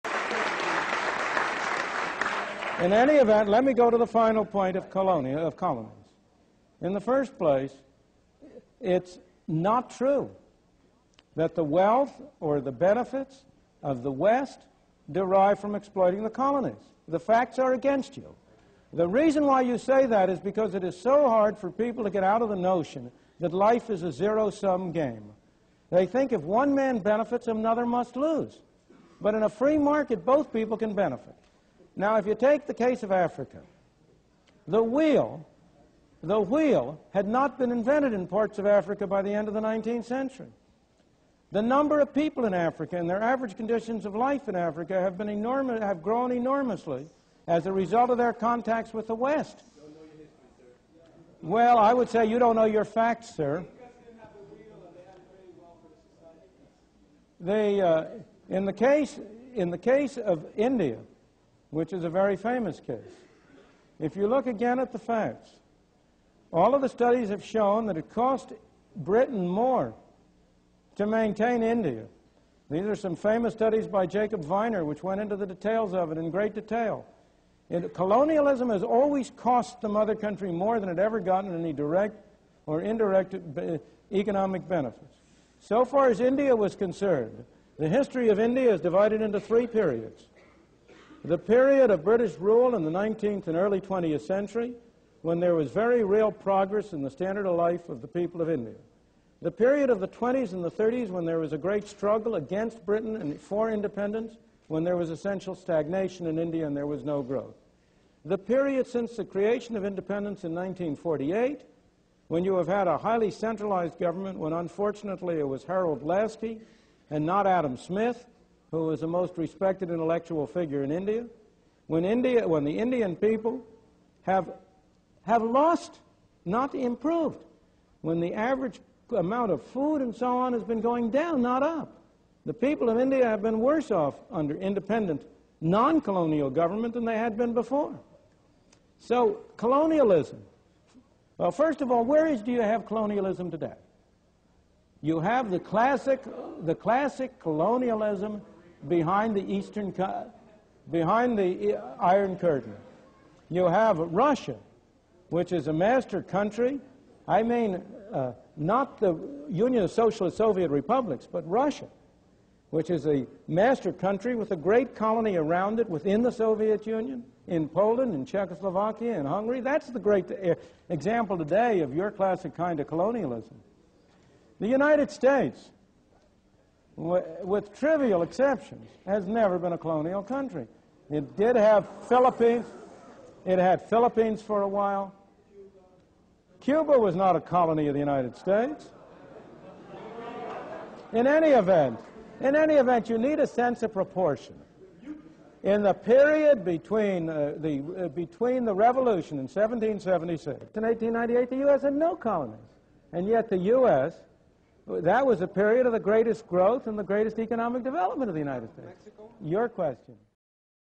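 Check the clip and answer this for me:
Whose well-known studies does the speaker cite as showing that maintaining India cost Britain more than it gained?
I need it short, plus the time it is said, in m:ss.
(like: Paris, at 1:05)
Jacob Viner, at 1:14.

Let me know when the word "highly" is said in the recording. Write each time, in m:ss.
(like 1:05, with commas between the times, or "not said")
1:52.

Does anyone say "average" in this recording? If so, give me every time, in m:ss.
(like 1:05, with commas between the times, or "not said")
0:43, 2:08.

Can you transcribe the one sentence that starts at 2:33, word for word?
You have Russia, which is a master country.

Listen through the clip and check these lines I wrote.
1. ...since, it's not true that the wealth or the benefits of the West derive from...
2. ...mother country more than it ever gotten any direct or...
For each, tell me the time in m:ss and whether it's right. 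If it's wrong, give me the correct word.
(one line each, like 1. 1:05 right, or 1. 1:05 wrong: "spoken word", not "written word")
1. 0:07 wrong: "place", not "since"
2. 1:19 right.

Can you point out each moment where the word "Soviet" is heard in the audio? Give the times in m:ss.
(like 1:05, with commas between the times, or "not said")
2:40, 2:46.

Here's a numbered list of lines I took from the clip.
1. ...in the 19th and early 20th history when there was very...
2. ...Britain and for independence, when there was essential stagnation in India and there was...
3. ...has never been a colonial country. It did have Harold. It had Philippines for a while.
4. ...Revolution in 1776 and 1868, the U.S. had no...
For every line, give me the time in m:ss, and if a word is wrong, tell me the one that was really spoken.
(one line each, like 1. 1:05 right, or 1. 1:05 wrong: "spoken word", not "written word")
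1. 1:32 wrong: "century", not "history"
2. 1:42 right
3. 2:59 wrong: "Philippines", not "Harold"
4. 3:18 wrong: "1898", not "1868".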